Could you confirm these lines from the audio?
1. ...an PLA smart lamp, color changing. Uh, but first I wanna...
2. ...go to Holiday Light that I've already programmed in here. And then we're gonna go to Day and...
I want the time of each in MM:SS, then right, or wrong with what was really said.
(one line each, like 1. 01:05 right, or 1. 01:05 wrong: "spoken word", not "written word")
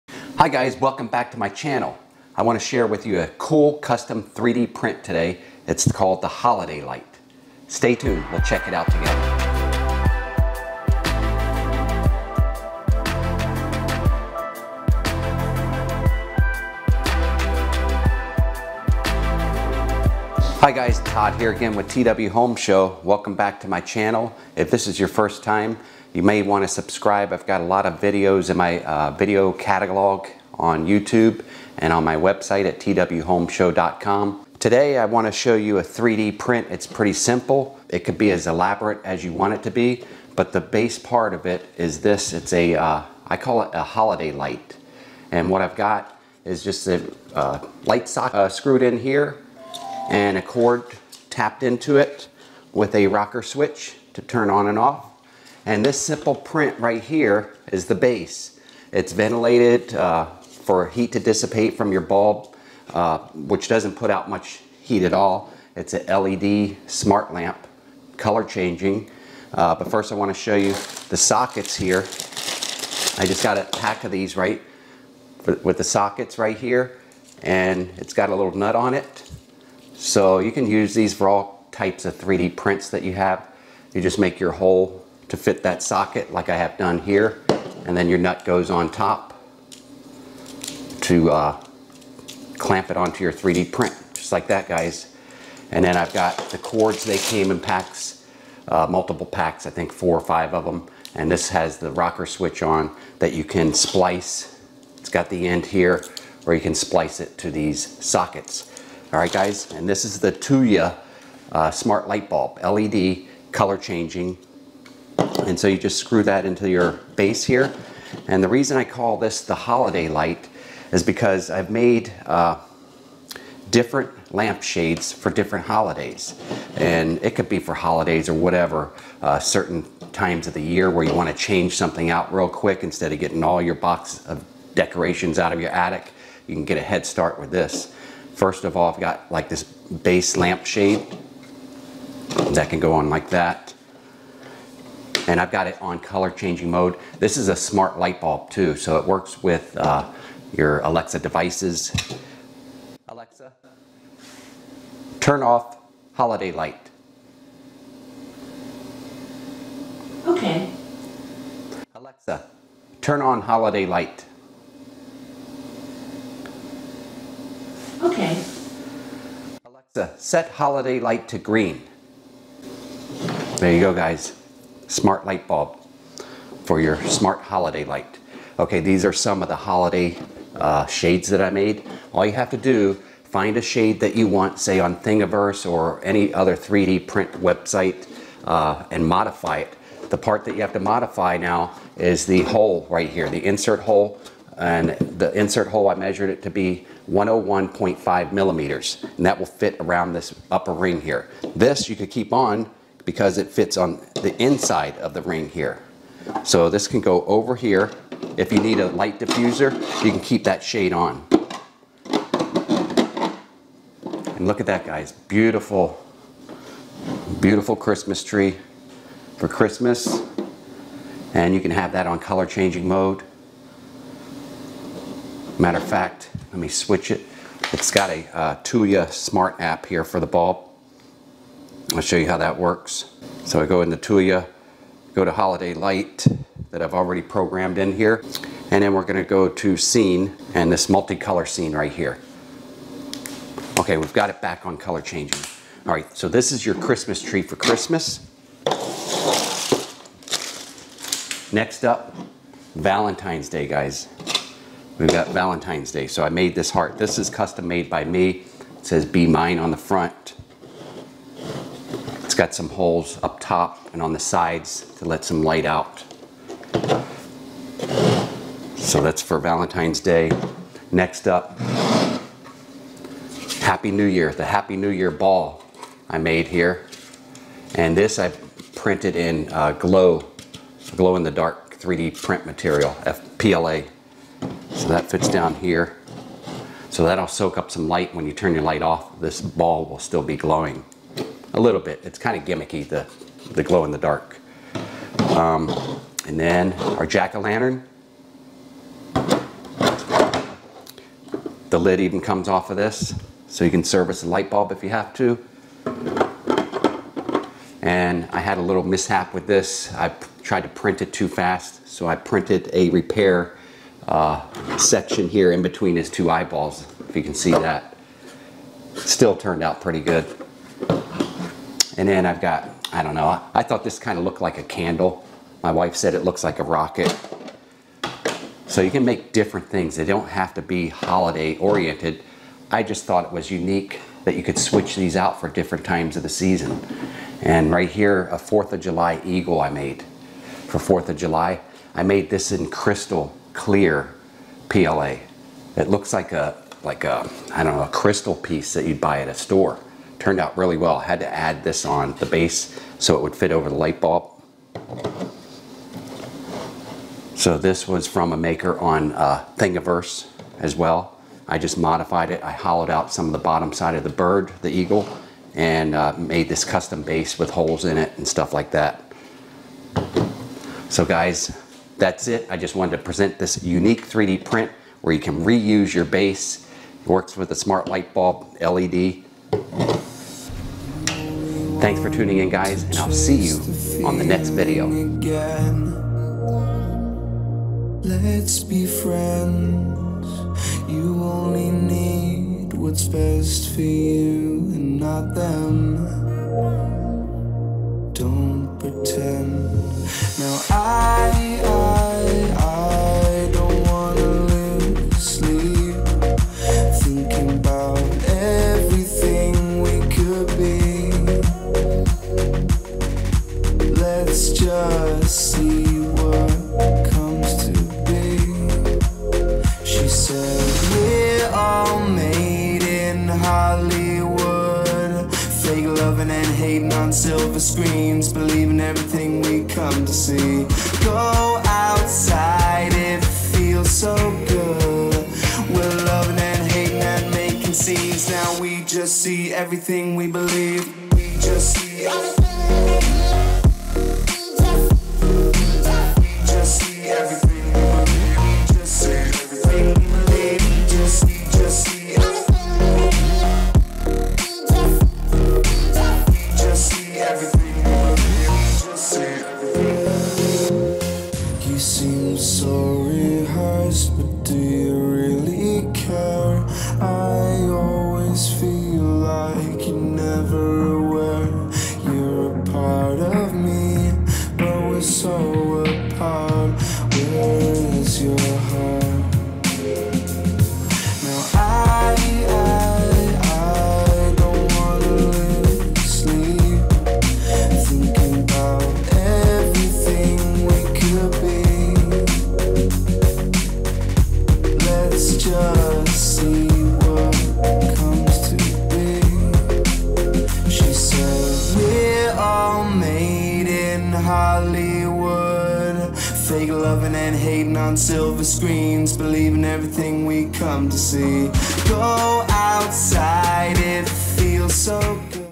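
1. 01:05 wrong: "LED", not "PLA"
2. 03:55 wrong: "Scene", not "Day".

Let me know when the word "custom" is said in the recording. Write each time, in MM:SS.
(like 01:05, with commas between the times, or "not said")
00:03, 04:17, 06:06.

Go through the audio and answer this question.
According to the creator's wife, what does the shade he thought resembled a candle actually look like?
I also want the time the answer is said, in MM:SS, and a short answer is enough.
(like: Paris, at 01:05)
A rocket, at 05:26.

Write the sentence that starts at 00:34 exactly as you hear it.
Today I want to show you a 3D print.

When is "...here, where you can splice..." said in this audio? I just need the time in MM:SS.
01:45.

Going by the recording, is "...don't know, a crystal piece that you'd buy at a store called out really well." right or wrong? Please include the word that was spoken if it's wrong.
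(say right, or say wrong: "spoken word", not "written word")
wrong: "turned", not "called".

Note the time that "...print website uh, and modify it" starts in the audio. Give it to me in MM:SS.
03:07.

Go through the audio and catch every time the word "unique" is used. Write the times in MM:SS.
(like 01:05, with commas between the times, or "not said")
05:33, 06:13.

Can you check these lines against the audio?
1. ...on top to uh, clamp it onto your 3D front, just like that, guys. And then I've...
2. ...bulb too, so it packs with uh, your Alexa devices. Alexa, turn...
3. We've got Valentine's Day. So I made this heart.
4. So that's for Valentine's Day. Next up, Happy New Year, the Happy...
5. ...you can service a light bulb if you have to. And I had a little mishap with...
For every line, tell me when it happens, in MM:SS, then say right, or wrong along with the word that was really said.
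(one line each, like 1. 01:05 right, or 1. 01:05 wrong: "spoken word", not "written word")
1. 01:28 wrong: "print", not "front"
2. 02:28 wrong: "works", not "packs"
3. 04:14 right
4. 04:28 right
5. 05:03 right.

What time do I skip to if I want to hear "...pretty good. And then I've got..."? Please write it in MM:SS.
05:19.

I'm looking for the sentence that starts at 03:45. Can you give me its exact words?
Matter of fact, let me switch it.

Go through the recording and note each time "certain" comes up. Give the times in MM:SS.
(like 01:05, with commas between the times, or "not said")
02:09.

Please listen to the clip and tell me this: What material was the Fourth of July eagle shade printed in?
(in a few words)
Crystal clear PLA.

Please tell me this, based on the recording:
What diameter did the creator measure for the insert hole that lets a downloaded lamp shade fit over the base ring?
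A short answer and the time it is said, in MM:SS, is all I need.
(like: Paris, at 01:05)
101.5 millimeters, at 03:17.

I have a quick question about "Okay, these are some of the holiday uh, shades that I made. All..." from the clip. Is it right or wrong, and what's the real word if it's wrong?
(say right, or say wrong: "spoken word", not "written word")
right.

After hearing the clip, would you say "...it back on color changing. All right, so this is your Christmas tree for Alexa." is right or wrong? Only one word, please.
wrong.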